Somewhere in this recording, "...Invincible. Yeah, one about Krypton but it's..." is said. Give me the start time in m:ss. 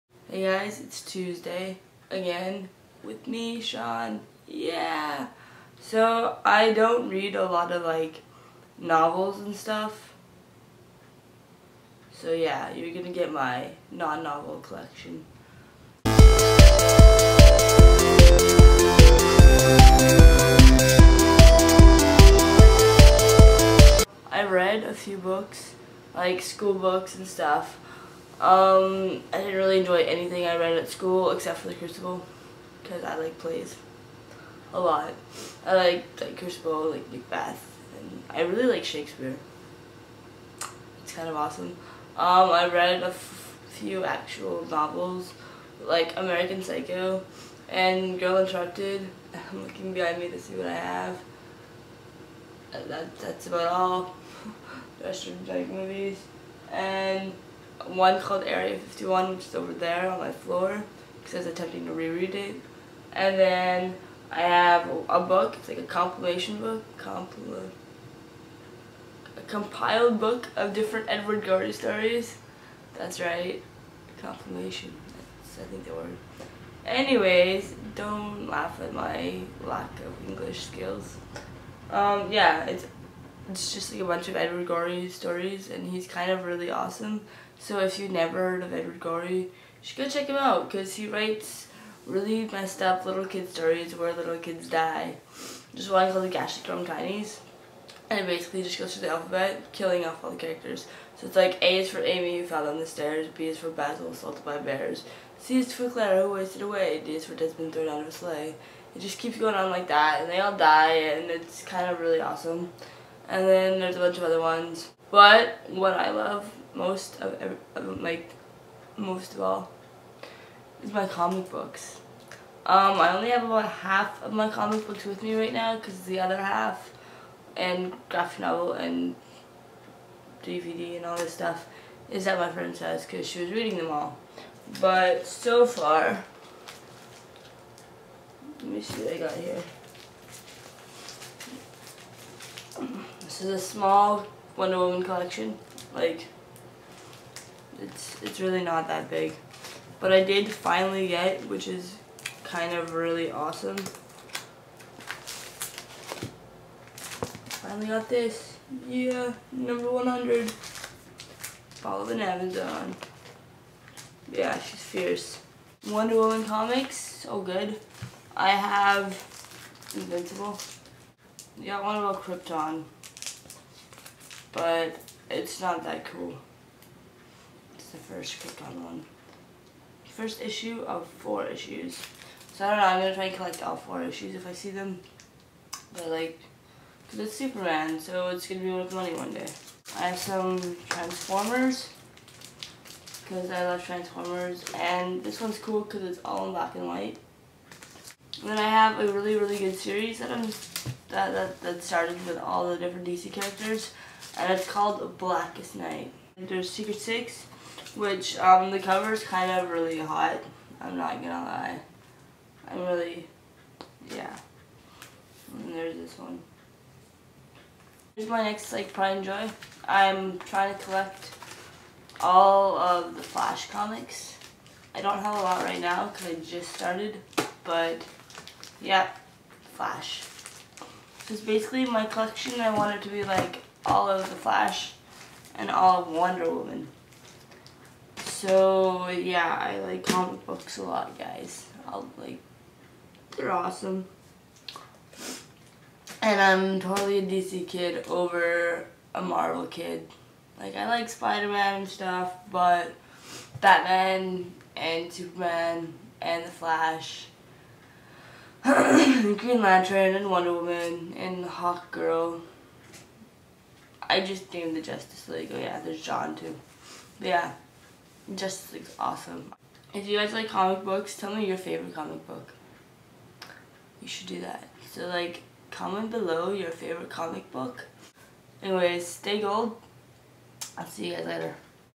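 2:49.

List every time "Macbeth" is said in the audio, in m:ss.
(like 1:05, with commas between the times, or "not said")
0:37.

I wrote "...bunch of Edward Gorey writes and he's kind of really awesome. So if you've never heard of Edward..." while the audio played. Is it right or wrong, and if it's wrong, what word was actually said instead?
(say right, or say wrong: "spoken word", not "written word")
wrong: "stories", not "writes".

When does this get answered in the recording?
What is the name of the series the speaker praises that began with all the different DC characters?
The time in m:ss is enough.
3:25.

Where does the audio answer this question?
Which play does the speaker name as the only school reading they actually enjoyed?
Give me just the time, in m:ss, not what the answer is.
0:31.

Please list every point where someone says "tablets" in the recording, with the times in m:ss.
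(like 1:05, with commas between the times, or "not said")
not said.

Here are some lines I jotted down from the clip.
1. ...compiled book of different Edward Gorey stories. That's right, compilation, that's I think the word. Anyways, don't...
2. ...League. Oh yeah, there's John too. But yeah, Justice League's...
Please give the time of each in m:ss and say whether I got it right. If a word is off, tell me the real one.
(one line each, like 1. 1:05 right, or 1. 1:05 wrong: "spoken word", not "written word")
1. 1:09 right
2. 4:25 right.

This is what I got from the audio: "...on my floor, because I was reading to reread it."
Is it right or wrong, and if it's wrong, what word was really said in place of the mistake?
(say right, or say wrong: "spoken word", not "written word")
wrong: "attempting", not "reading".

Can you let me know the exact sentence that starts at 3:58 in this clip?
So yeah, I like comic books a lot, guys.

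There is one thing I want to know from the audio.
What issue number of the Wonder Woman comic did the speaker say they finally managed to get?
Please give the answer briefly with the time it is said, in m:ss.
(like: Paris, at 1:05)
100, at 2:39.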